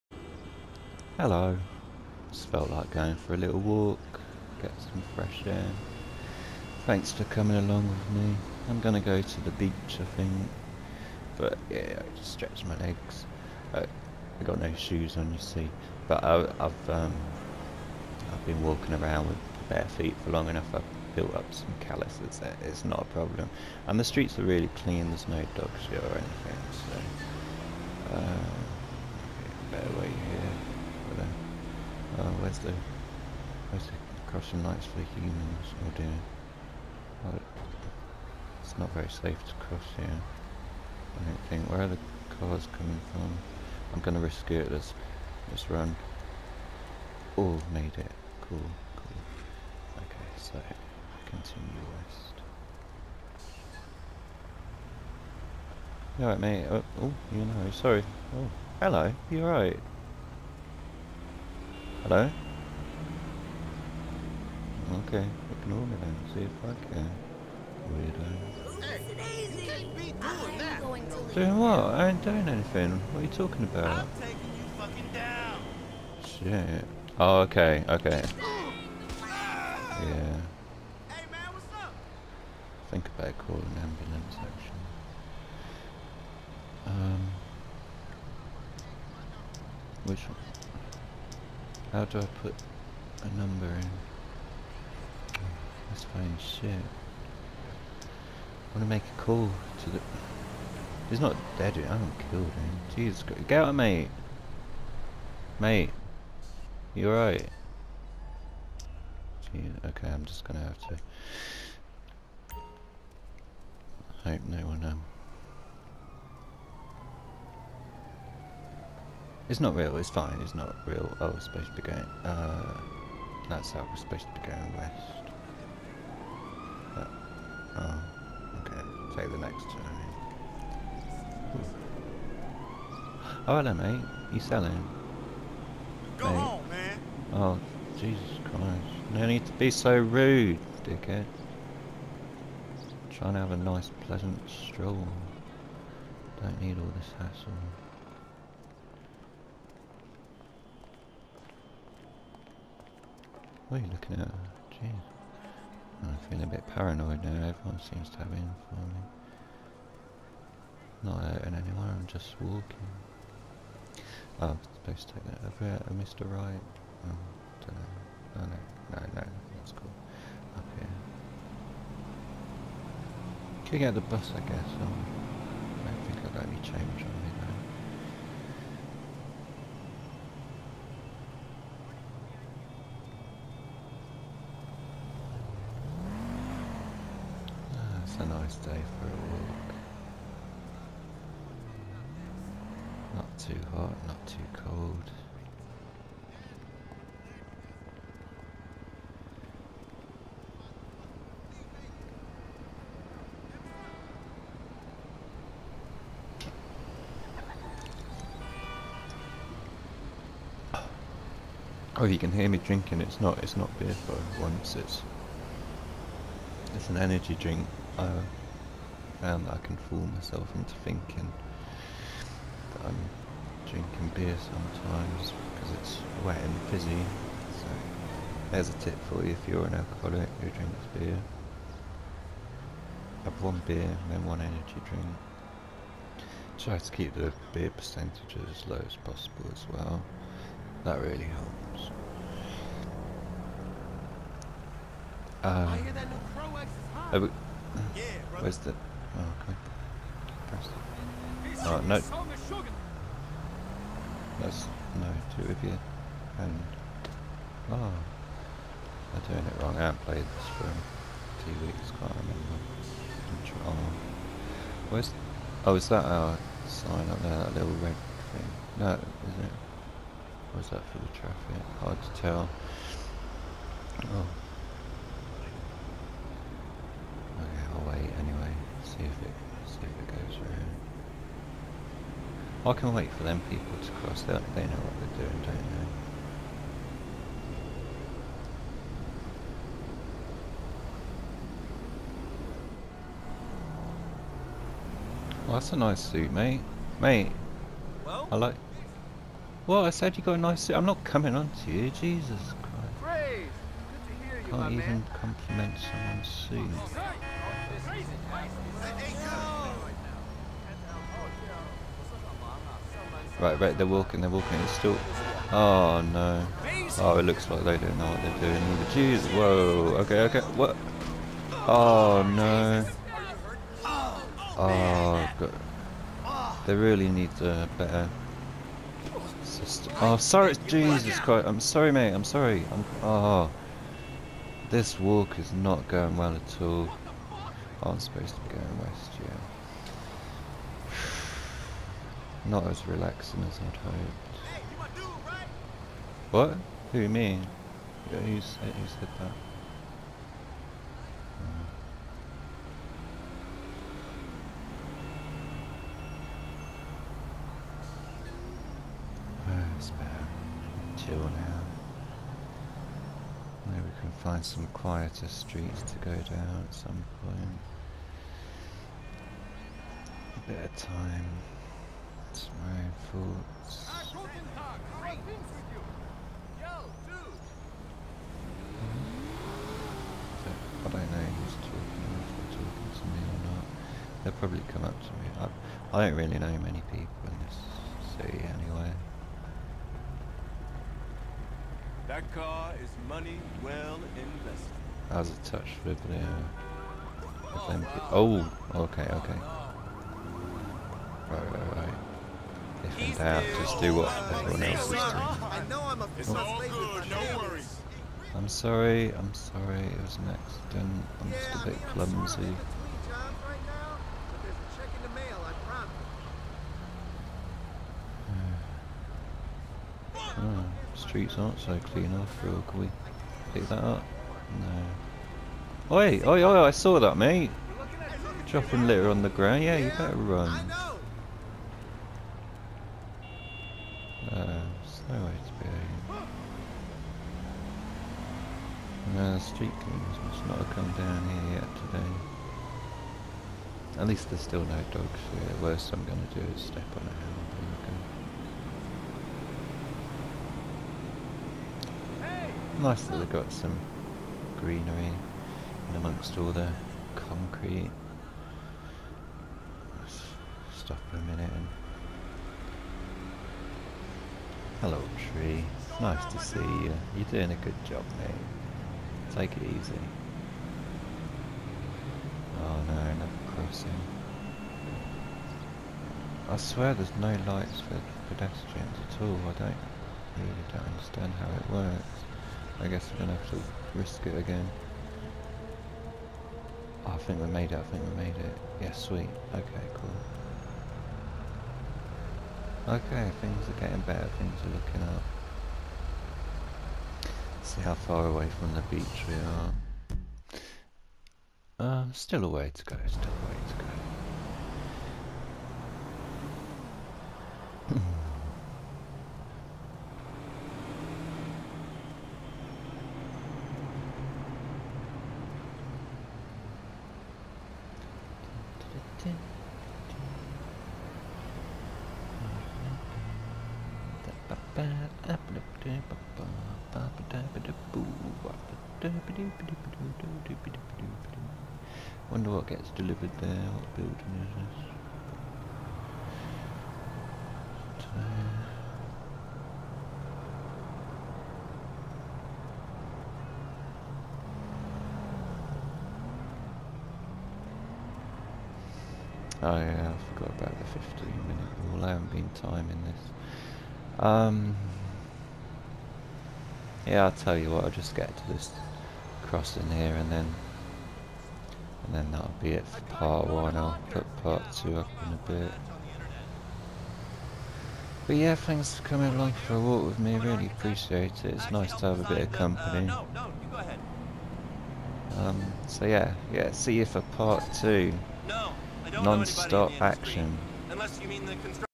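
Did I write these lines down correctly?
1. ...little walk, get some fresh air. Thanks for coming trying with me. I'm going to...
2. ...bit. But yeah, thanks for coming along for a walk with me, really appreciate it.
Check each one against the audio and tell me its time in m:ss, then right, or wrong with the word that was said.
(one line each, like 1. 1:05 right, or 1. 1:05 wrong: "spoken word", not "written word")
1. 0:03 wrong: "along", not "trying"
2. 9:25 right.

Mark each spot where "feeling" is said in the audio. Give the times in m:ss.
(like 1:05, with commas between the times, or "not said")
2:36.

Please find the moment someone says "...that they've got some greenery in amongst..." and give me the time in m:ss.
7:33.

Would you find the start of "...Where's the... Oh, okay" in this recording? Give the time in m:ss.
4:08.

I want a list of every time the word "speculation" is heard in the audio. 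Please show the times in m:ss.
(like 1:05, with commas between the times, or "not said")
not said.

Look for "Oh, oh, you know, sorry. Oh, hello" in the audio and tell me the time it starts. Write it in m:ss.
0:56.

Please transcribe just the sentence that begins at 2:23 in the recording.
trying to have a nice, pleasant stroll.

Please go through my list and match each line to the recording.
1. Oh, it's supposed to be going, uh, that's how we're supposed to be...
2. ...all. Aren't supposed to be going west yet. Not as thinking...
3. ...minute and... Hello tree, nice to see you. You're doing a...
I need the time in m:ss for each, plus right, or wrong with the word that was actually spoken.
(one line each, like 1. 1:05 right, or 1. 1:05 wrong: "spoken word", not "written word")
1. 2:01 right
2. 5:36 wrong: "relaxing", not "thinking"
3. 7:41 right.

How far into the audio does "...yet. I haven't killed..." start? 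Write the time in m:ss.
1:41.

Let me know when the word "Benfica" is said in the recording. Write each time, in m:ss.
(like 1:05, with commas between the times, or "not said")
not said.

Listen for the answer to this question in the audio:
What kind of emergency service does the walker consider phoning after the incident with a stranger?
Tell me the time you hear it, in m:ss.
1:23.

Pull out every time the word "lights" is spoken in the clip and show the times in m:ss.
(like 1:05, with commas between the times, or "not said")
0:34, 7:57.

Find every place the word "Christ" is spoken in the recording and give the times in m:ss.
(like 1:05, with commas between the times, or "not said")
1:43, 2:18, 5:02, 5:31.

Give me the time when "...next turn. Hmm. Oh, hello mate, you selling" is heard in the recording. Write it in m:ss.
2:09.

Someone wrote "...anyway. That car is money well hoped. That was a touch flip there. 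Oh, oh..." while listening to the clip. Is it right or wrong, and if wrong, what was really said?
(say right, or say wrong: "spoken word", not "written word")
wrong: "invested", not "hoped".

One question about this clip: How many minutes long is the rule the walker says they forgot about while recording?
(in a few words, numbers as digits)
15.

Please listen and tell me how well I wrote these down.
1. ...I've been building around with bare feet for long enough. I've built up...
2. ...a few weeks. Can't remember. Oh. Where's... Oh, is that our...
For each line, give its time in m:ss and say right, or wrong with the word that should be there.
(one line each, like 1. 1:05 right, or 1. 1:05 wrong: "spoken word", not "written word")
1. 0:18 wrong: "walking", not "building"
2. 4:20 right.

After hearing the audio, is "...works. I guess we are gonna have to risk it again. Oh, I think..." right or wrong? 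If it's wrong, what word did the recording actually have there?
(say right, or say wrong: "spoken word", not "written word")
right.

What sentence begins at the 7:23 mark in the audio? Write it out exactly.
At least there's still no dogs here.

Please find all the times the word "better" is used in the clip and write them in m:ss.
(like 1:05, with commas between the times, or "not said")
0:29, 5:27, 7:09, 8:14.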